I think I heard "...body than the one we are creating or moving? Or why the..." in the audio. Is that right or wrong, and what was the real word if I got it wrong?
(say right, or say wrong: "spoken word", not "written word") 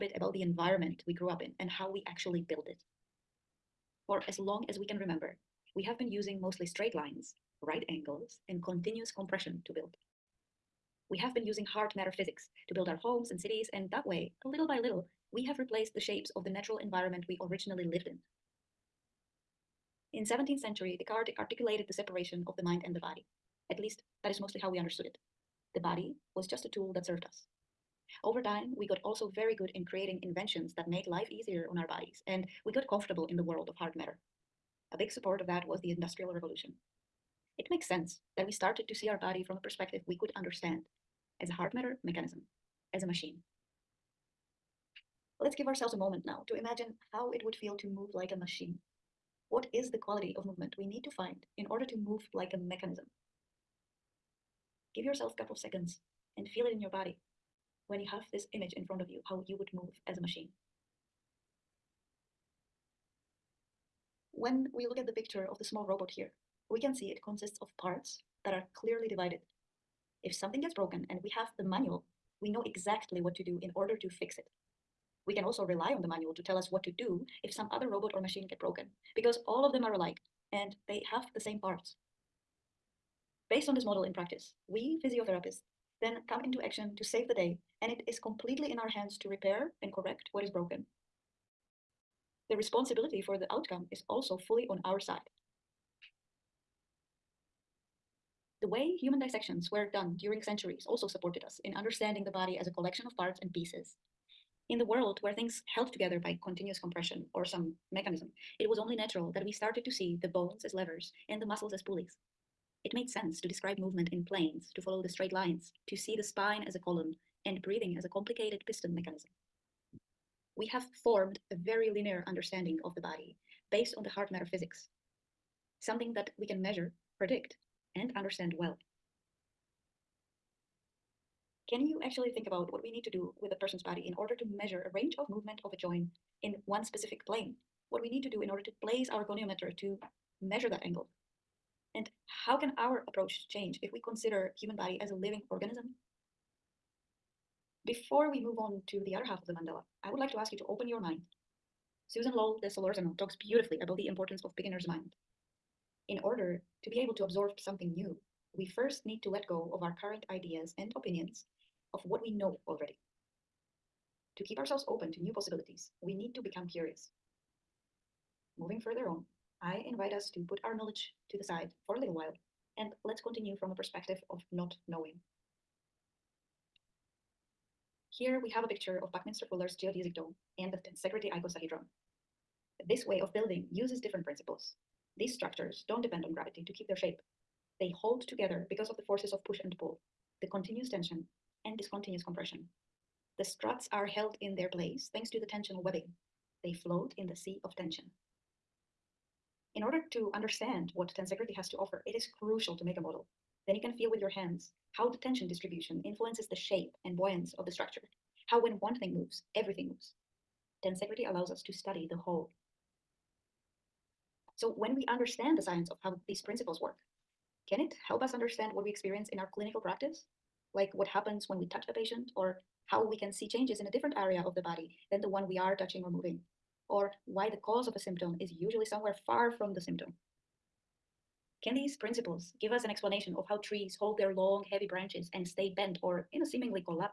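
wrong: "touching", not "creating".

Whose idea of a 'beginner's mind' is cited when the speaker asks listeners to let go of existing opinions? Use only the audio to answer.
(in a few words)
Susan Lowell de Solorzano.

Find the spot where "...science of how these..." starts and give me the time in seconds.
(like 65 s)
215 s.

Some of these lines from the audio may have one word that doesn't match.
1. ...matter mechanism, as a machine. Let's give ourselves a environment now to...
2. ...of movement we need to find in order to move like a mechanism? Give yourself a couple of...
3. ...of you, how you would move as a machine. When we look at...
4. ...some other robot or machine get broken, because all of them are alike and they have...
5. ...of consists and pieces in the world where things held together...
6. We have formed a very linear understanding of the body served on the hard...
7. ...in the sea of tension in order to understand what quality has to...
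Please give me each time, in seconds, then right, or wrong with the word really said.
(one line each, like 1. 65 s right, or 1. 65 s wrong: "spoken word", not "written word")
1. 41 s wrong: "moment", not "environment"
2. 50 s right
3. 59 s right
4. 77 s right
5. 103 s wrong: "parts", not "consists"
6. 120 s wrong: "based", not "served"
7. 197 s wrong: "tensegrity", not "quality".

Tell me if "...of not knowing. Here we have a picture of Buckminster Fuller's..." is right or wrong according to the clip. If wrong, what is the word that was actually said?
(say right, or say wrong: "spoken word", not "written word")
right.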